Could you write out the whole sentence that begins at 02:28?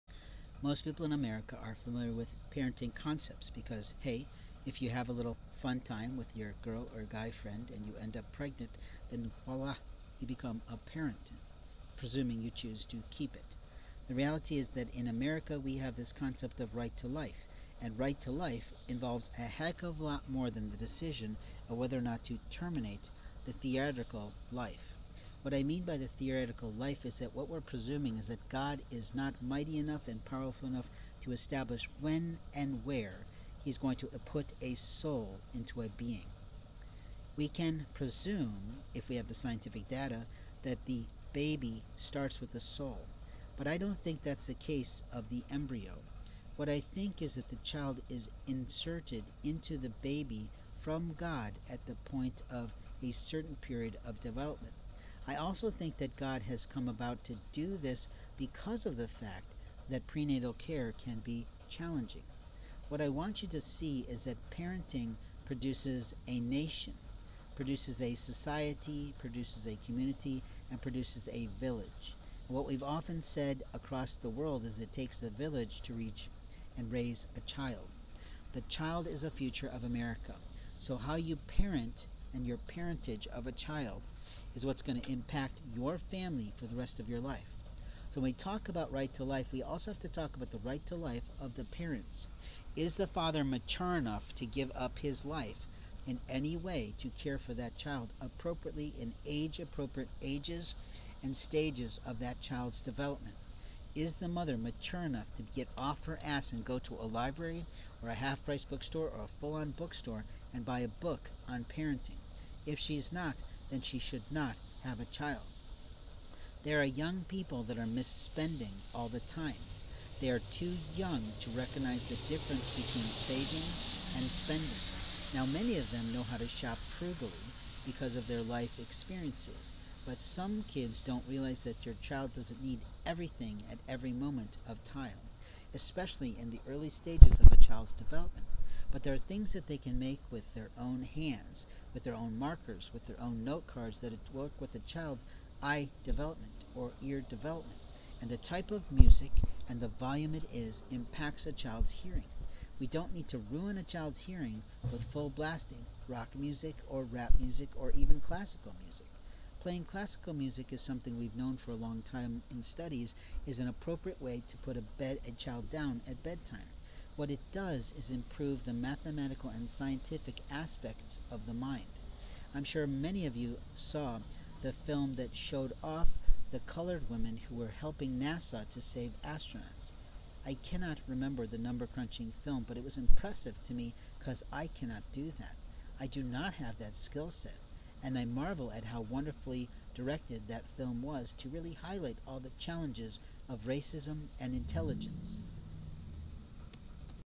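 And the type of music and the volume it is impacts a child's hearing.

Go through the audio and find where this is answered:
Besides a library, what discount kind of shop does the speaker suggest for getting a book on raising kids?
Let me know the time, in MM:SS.
01:48.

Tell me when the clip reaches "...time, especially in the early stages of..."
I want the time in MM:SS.
02:14.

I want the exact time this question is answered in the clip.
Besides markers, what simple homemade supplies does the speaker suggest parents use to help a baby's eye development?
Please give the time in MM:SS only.
02:23.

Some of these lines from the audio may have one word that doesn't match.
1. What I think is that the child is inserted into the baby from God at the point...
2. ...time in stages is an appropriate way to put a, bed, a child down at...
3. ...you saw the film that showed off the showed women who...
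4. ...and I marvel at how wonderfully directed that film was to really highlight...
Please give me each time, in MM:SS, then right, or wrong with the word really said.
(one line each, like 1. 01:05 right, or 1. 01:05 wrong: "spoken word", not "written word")
1. 00:46 right
2. 02:42 wrong: "studies", not "stages"
3. 02:53 wrong: "colored", not "showed"
4. 03:08 right.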